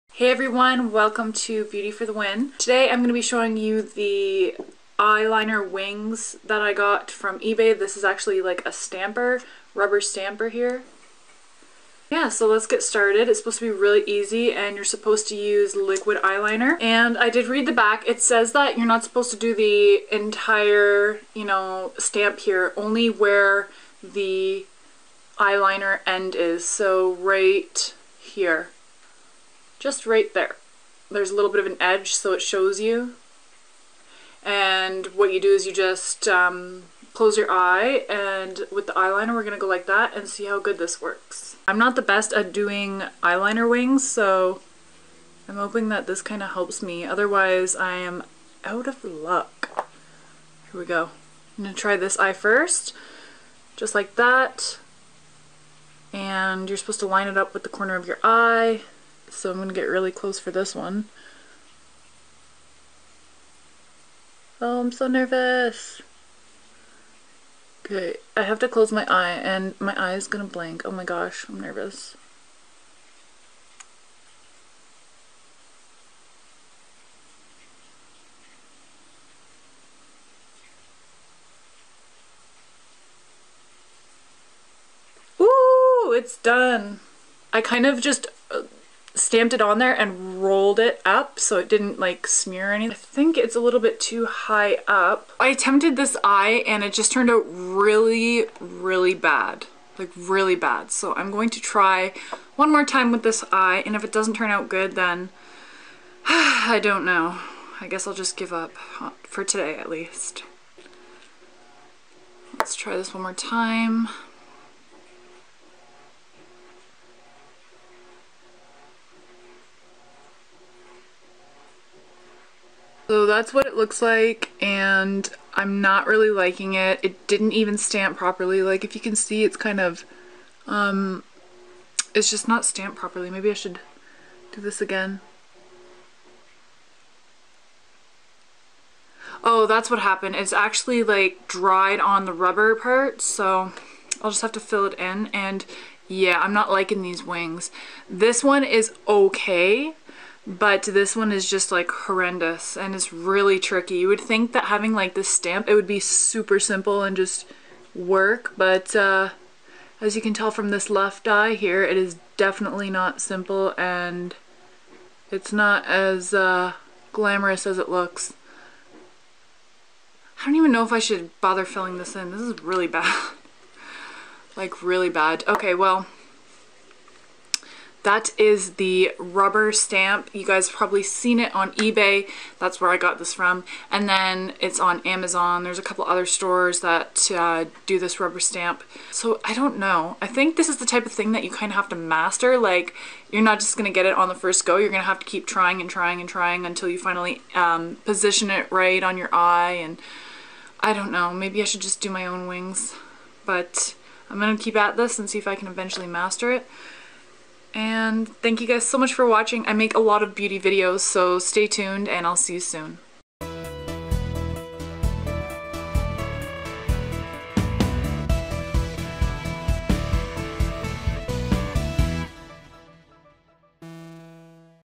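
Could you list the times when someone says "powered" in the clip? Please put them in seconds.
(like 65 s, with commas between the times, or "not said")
not said.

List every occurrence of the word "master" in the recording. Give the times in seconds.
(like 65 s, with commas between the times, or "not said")
191 s, 206 s.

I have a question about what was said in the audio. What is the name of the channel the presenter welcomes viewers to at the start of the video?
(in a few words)
Beauty for the Win.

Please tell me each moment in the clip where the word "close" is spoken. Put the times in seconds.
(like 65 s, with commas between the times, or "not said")
37 s, 60 s, 68 s.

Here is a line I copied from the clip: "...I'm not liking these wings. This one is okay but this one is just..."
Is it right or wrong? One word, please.
right.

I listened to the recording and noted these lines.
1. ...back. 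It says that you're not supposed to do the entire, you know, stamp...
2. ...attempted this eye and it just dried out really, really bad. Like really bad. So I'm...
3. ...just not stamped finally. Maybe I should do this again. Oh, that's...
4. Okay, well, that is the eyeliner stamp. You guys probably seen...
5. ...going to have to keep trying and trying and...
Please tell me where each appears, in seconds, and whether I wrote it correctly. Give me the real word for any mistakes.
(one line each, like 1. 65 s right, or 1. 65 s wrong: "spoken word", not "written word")
1. 17 s right
2. 95 s wrong: "turned", not "dried"
3. 132 s wrong: "properly", not "finally"
4. 175 s wrong: "rubber", not "eyeliner"
5. 194 s right.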